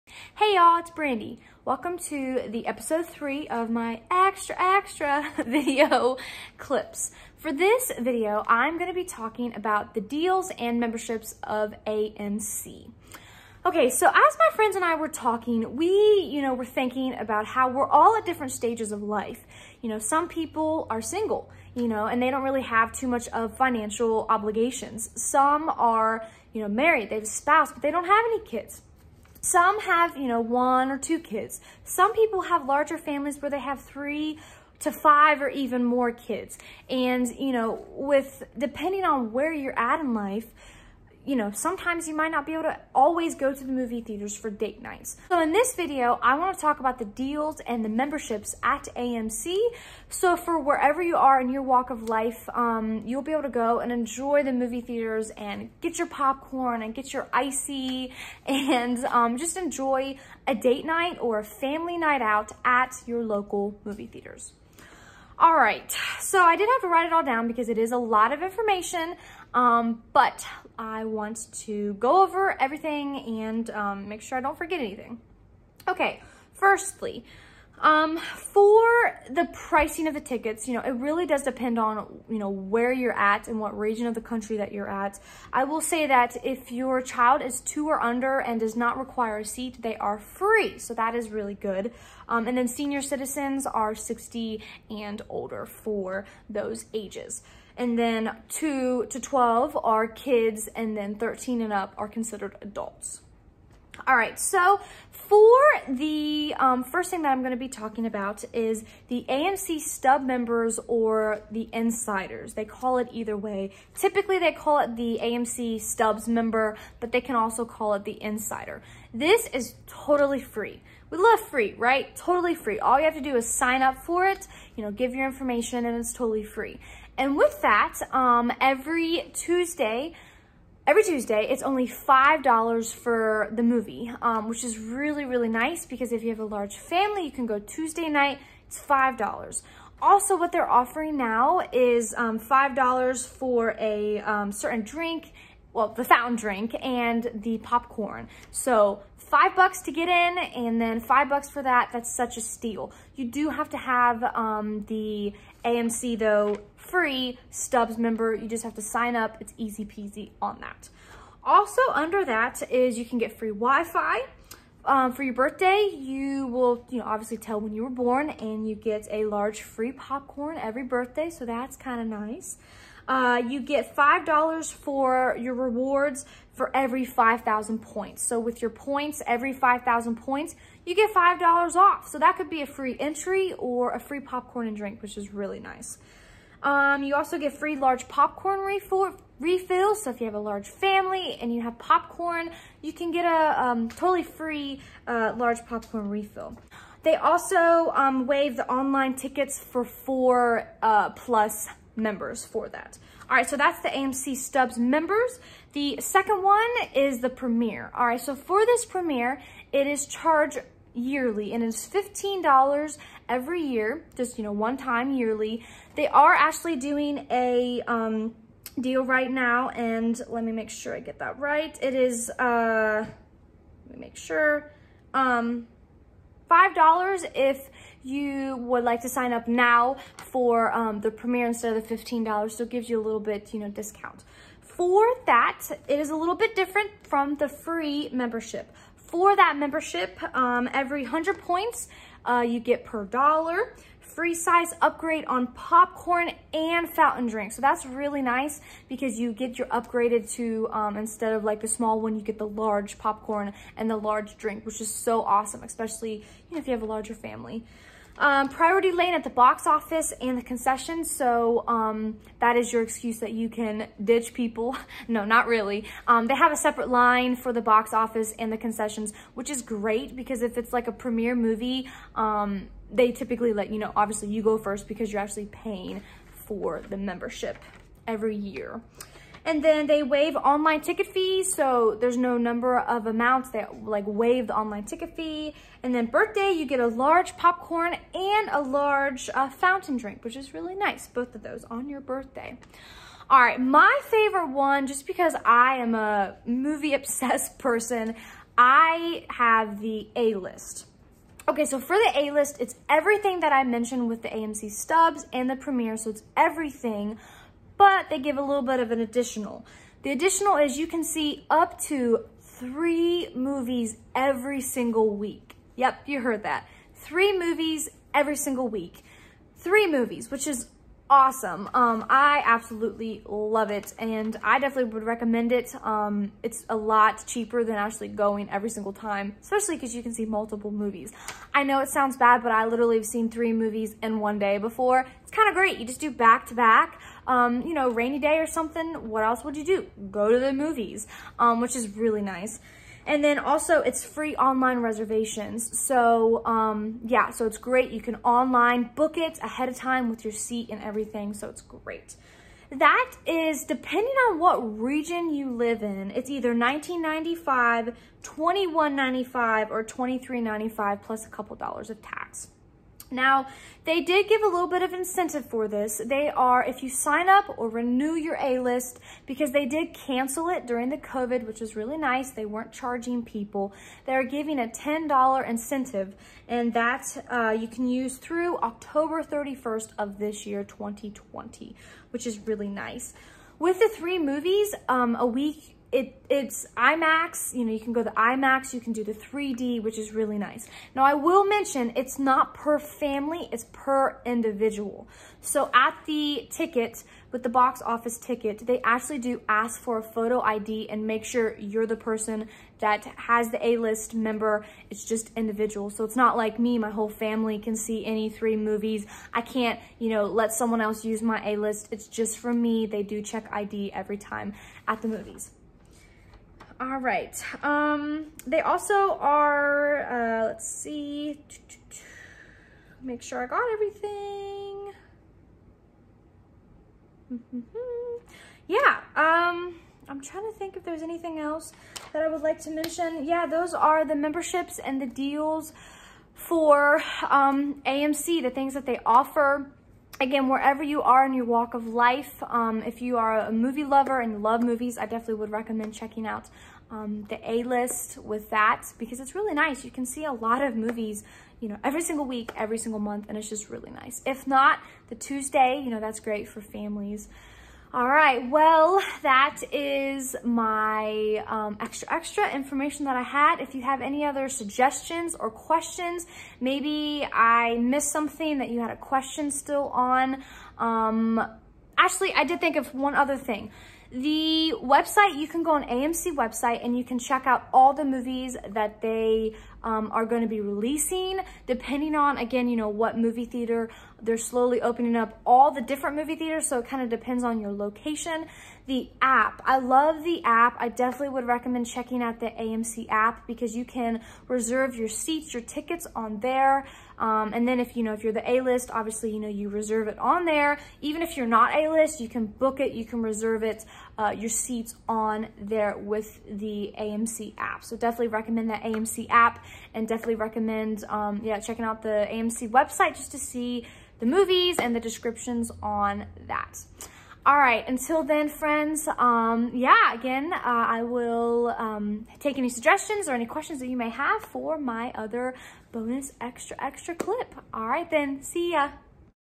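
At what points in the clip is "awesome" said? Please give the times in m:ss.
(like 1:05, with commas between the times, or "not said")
4:15, 5:21.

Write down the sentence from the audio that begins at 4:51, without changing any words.
Both of those on your birthday.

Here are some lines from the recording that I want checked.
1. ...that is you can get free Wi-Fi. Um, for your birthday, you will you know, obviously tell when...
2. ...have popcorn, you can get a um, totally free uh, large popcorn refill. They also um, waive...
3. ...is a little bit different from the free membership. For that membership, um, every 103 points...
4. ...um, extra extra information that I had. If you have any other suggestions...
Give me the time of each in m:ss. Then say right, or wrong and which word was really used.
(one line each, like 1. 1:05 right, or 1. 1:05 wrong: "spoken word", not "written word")
1. 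2:42 right
2. 3:11 right
3. 3:55 wrong: "100", not "103"
4. 7:41 right.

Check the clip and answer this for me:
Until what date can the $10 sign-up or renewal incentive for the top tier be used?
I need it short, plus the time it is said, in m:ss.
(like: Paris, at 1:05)
October 31, at 6:18.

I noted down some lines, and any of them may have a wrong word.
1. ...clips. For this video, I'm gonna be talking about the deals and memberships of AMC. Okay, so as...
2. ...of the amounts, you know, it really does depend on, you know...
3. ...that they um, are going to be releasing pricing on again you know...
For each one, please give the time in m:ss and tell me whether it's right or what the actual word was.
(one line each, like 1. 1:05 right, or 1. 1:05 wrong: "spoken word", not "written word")
1. 0:06 right
2. 1:20 wrong: "tickets", not "amounts"
3. 7:58 wrong: "depending", not "pricing".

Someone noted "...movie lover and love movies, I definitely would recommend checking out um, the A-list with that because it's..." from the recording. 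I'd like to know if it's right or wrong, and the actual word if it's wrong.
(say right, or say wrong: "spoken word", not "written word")
right.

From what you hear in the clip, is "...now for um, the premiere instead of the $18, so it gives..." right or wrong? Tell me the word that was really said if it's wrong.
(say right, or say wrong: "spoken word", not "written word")
wrong: "15", not "18".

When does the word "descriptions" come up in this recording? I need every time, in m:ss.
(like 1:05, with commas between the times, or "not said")
8:34.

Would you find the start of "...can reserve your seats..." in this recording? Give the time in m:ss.
8:13.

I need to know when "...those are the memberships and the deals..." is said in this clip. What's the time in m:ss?
7:13.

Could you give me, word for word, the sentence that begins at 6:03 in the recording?
Now, they did give a little bit of incentive for this.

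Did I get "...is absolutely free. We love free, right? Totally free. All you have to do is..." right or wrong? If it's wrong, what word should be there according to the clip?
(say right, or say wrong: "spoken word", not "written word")
wrong: "totally", not "absolutely".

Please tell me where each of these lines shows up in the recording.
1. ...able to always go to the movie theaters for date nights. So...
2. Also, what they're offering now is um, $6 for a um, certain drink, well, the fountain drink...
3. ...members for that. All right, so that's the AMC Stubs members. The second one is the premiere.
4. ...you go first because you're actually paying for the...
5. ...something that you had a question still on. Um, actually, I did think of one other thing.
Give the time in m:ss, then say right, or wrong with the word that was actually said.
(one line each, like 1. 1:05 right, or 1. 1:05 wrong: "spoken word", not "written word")
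1. 0:42 right
2. 2:20 wrong: "5", not "6"
3. 3:22 right
4. 4:34 right
5. 7:48 right.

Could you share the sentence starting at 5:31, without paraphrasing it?
I know it sounds bad, but I literally have seen three movies in one day before.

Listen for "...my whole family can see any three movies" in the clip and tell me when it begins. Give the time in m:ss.
6:46.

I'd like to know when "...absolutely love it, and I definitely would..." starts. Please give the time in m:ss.
5:22.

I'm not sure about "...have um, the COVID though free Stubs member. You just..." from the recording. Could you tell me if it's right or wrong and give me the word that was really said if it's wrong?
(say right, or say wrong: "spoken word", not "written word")
wrong: "AMC", not "COVID".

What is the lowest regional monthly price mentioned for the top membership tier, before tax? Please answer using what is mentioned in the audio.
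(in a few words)
19.95.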